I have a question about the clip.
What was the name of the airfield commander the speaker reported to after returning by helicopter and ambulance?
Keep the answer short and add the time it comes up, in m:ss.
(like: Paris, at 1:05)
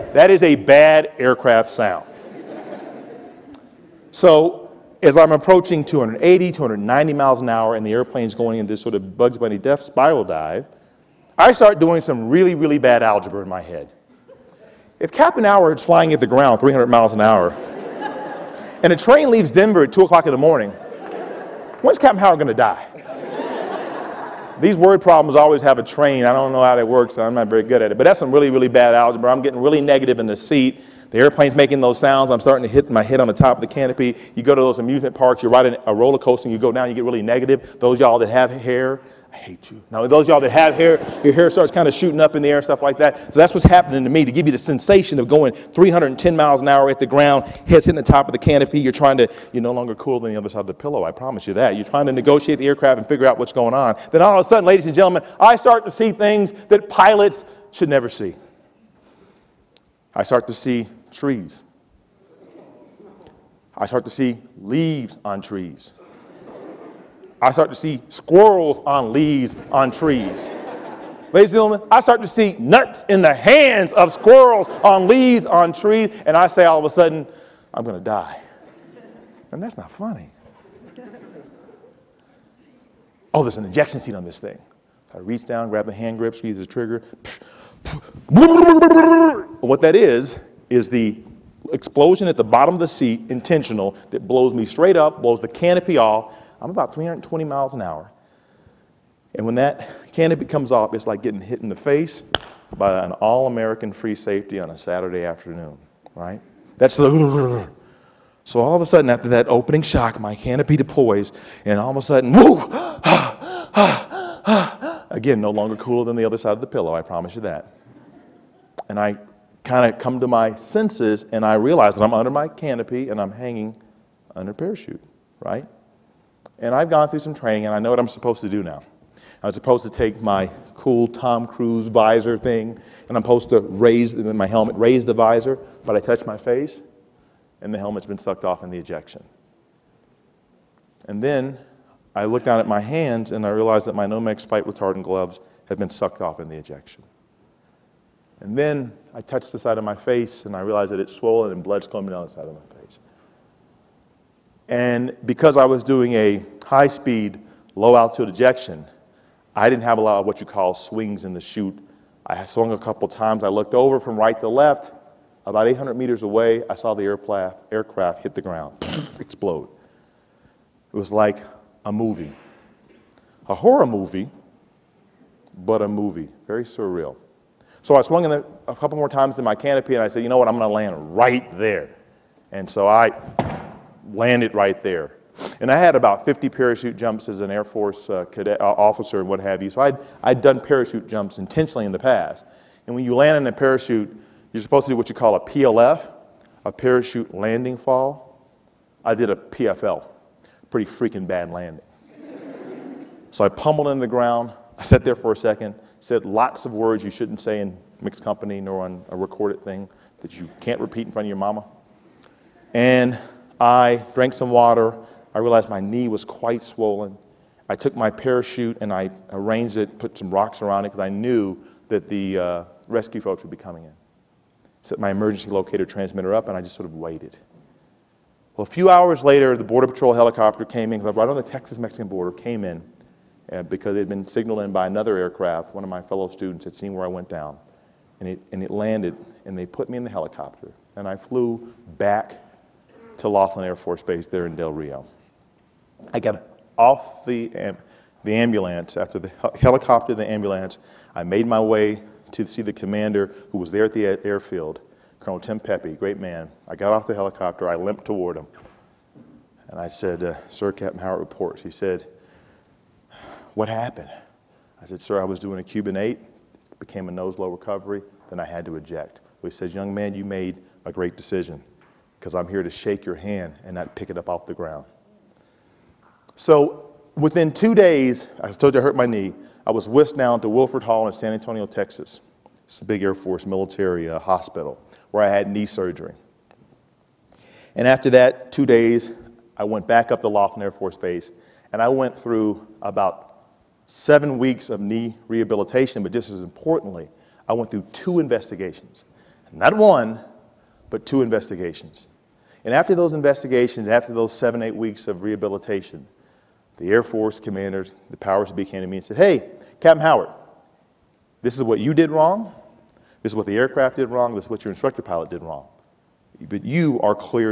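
Colonel Tim Pepe, at 4:15.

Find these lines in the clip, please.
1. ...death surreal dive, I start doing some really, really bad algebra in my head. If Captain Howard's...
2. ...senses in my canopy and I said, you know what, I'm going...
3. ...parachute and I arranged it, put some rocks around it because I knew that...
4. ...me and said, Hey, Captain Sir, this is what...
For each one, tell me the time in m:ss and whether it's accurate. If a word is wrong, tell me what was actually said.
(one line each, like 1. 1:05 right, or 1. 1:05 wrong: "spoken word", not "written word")
1. 0:09 wrong: "spiral", not "surreal"
2. 2:59 wrong: "times", not "senses"
3. 3:38 right
4. 5:08 wrong: "Howard", not "Sir".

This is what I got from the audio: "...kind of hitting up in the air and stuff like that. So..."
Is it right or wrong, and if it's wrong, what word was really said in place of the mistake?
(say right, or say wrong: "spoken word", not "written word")
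wrong: "shooting", not "hitting".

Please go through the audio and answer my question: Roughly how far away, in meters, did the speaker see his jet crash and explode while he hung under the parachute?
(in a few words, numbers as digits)
800 meters.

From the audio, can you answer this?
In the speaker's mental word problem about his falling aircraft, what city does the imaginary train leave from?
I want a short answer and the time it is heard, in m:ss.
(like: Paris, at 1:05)
Denver, at 0:19.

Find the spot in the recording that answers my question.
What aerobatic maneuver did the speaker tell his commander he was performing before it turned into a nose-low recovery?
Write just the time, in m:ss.
4:25.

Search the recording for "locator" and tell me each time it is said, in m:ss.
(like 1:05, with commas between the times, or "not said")
3:45.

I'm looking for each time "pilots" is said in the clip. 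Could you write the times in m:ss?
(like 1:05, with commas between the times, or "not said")
0:56, 5:15.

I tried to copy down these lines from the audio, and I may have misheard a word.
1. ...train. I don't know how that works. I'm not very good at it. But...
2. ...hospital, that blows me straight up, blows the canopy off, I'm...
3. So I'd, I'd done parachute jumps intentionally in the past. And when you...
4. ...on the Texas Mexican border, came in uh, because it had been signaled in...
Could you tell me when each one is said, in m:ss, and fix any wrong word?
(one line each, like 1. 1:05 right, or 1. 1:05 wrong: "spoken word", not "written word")
1. 0:25 right
2. 1:33 wrong: "intentional", not "hospital"
3. 3:09 right
4. 3:51 right.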